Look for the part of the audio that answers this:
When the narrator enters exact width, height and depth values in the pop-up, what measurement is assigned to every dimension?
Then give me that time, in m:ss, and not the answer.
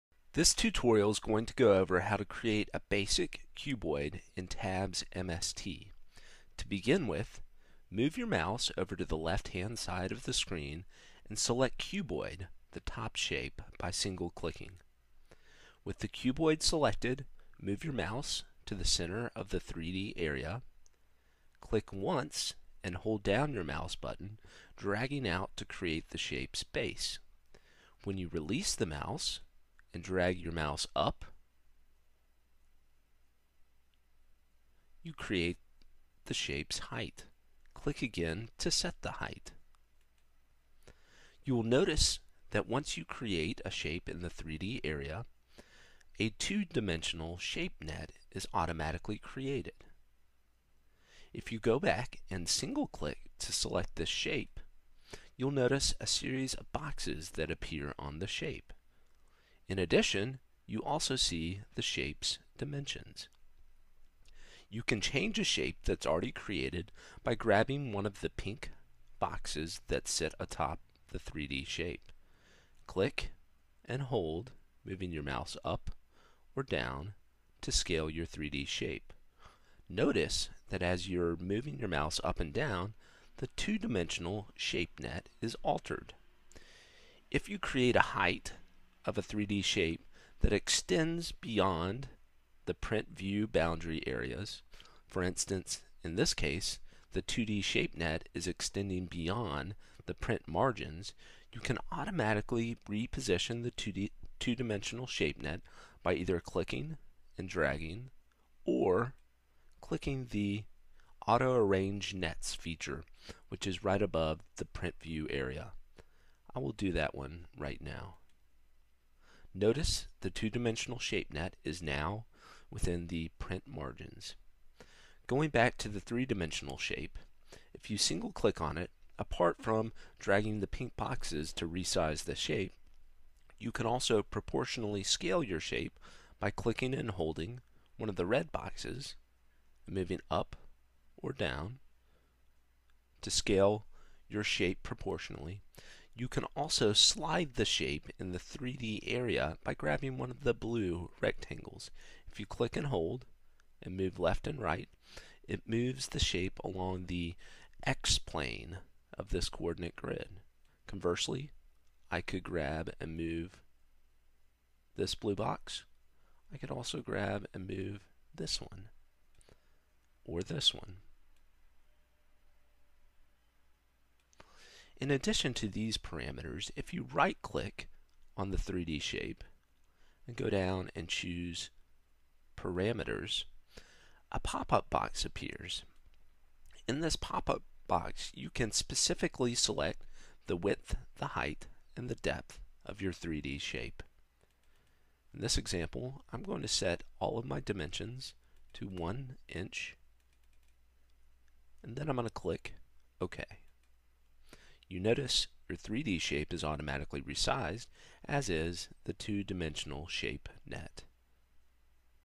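3:18.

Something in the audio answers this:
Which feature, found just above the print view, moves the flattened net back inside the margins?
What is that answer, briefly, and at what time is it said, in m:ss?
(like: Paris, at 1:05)
Auto Arrange Nets, at 1:51.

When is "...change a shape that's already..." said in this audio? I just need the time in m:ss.
1:05.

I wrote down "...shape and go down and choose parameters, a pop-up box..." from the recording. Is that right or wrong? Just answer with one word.
right.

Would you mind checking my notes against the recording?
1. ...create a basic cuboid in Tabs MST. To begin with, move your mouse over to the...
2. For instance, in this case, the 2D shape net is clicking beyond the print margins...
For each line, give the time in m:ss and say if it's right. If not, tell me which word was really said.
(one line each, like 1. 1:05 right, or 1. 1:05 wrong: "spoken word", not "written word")
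1. 0:02 right
2. 1:35 wrong: "extending", not "clicking".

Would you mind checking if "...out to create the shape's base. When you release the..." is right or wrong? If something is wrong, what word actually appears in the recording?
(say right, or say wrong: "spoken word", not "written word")
right.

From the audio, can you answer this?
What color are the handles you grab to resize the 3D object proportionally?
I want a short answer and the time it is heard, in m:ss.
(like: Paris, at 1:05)
red, at 2:18.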